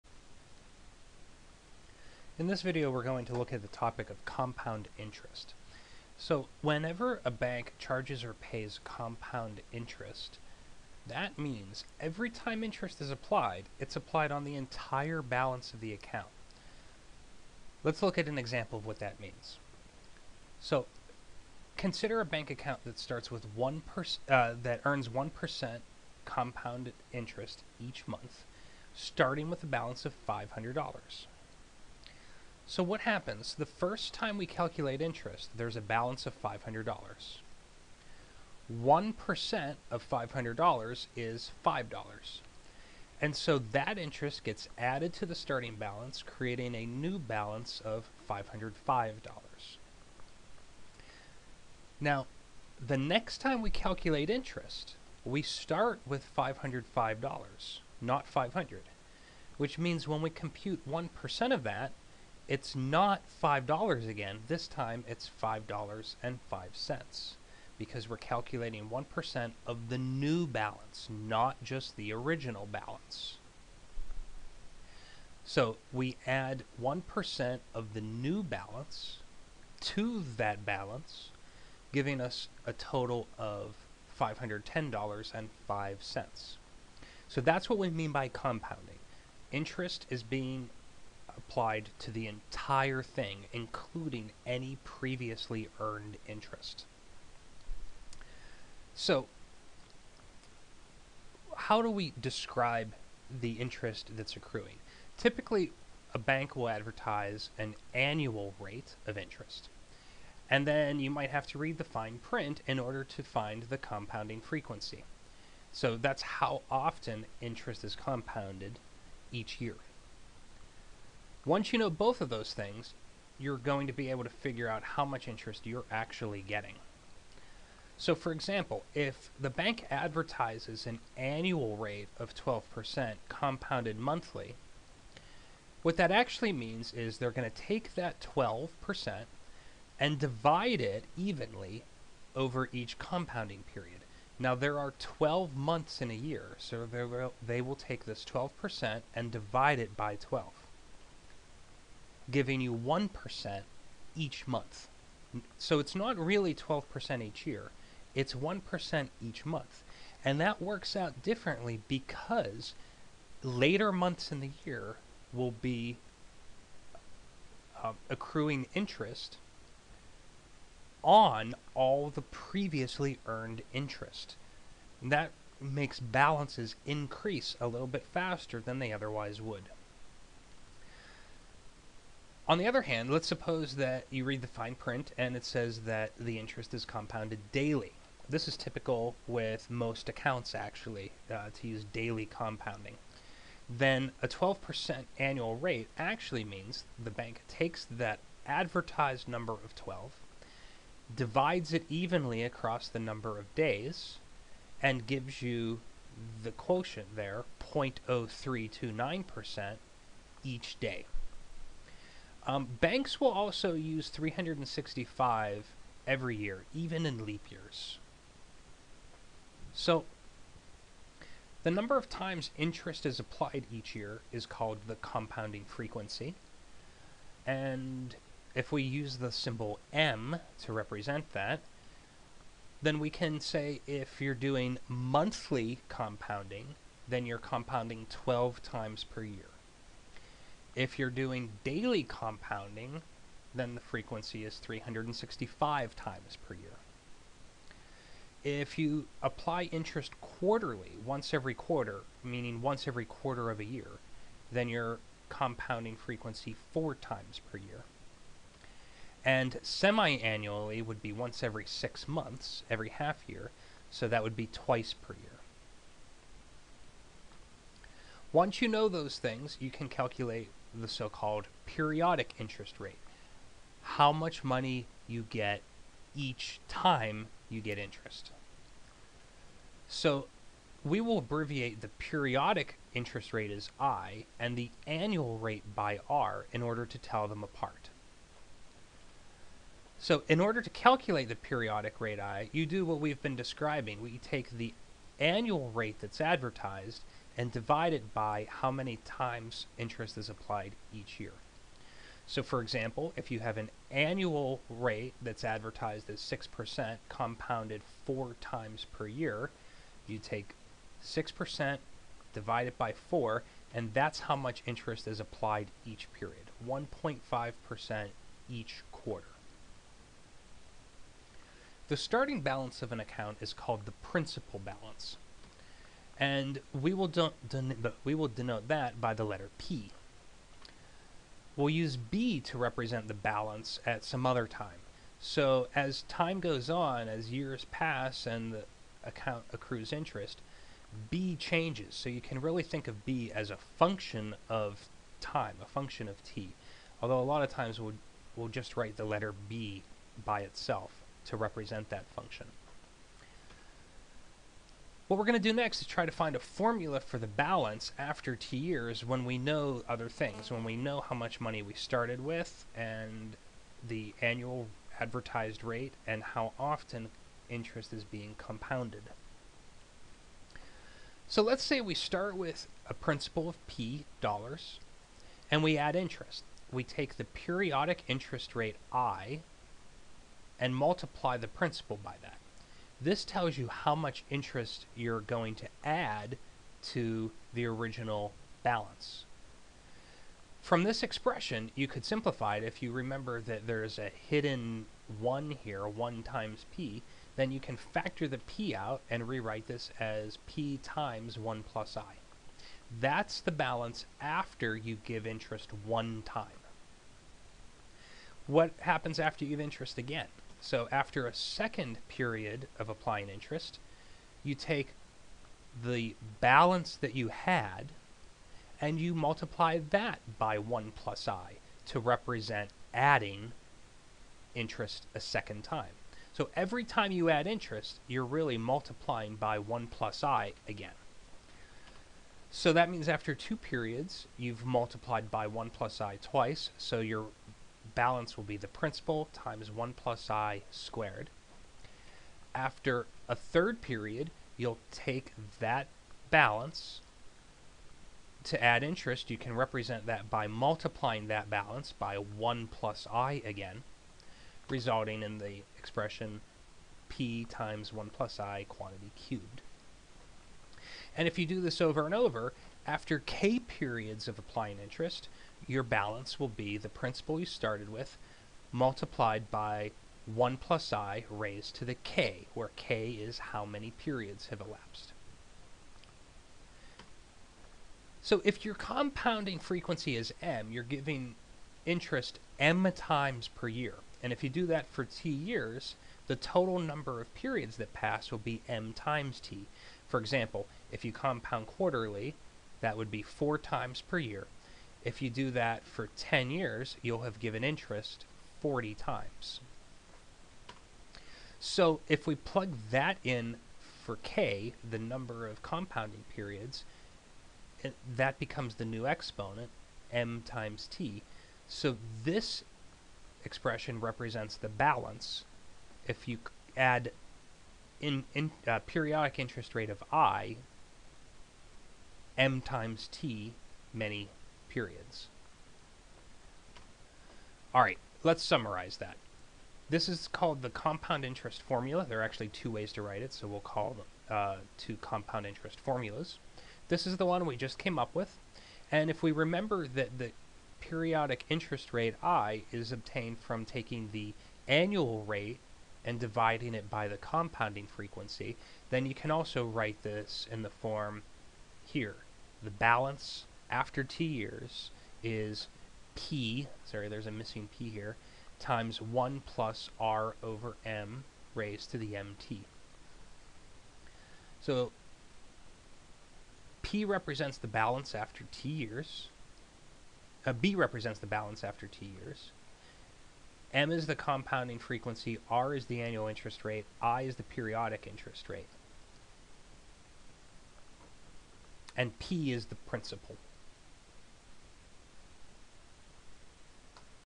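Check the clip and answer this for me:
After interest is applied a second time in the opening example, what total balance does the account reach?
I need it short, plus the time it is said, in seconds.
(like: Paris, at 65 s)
$510.05, at 84 s.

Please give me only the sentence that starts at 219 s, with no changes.
So, the number of times interest is applied each year is called the compounding frequency.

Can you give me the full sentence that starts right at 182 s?
On the other hand, let's suppose that you read the fine print and it says that the interest is compounded daily.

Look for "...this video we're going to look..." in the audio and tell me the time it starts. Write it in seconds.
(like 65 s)
2 s.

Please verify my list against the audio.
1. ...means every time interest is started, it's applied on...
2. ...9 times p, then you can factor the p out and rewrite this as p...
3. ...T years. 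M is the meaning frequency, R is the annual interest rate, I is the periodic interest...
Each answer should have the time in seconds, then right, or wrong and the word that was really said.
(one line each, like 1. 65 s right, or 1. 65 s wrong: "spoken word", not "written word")
1. 11 s wrong: "applied", not "started"
2. 395 s wrong: "1", not "9"
3. 571 s wrong: "compounding", not "meaning".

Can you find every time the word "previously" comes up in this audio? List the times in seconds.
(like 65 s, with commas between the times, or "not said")
94 s, 172 s.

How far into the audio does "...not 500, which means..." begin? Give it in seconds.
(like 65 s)
57 s.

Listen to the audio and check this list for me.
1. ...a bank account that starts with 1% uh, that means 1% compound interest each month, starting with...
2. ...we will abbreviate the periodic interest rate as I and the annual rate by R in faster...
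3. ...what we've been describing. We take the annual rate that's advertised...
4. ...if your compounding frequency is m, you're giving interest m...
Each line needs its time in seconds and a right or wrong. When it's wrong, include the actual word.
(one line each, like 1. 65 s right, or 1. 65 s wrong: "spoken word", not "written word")
1. 22 s wrong: "earns", not "means"
2. 280 s wrong: "order", not "faster"
3. 292 s right
4. 478 s right.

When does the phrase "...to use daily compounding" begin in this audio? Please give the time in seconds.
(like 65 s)
191 s.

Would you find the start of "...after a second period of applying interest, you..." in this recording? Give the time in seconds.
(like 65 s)
410 s.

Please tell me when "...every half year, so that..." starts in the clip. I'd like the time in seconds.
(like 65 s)
262 s.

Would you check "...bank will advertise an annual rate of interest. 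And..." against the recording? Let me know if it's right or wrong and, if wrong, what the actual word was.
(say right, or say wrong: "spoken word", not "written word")
right.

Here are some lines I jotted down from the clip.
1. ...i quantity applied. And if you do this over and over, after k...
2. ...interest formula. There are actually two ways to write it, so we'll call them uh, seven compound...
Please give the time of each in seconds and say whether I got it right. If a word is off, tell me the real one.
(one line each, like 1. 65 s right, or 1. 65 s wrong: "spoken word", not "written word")
1. 458 s wrong: "cubed", not "applied"
2. 531 s wrong: "two", not "seven".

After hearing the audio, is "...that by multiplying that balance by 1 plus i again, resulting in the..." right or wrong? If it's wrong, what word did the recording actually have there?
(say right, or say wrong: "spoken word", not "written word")
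right.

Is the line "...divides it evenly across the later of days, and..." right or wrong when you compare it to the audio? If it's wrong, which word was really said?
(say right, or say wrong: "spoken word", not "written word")
wrong: "number", not "later".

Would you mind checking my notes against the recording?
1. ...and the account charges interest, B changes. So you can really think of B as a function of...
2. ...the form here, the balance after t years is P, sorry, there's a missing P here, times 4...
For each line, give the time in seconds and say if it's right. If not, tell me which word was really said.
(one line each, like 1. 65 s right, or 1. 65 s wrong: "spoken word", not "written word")
1. 338 s wrong: "accrues", not "charges"
2. 550 s wrong: "1", not "4".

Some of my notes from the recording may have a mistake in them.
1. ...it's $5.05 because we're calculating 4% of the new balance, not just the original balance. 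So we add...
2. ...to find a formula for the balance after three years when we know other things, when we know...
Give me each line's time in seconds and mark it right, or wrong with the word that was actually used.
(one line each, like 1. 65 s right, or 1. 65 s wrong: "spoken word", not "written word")
1. 65 s wrong: "1", not "4"
2. 356 s wrong: "two", not "three".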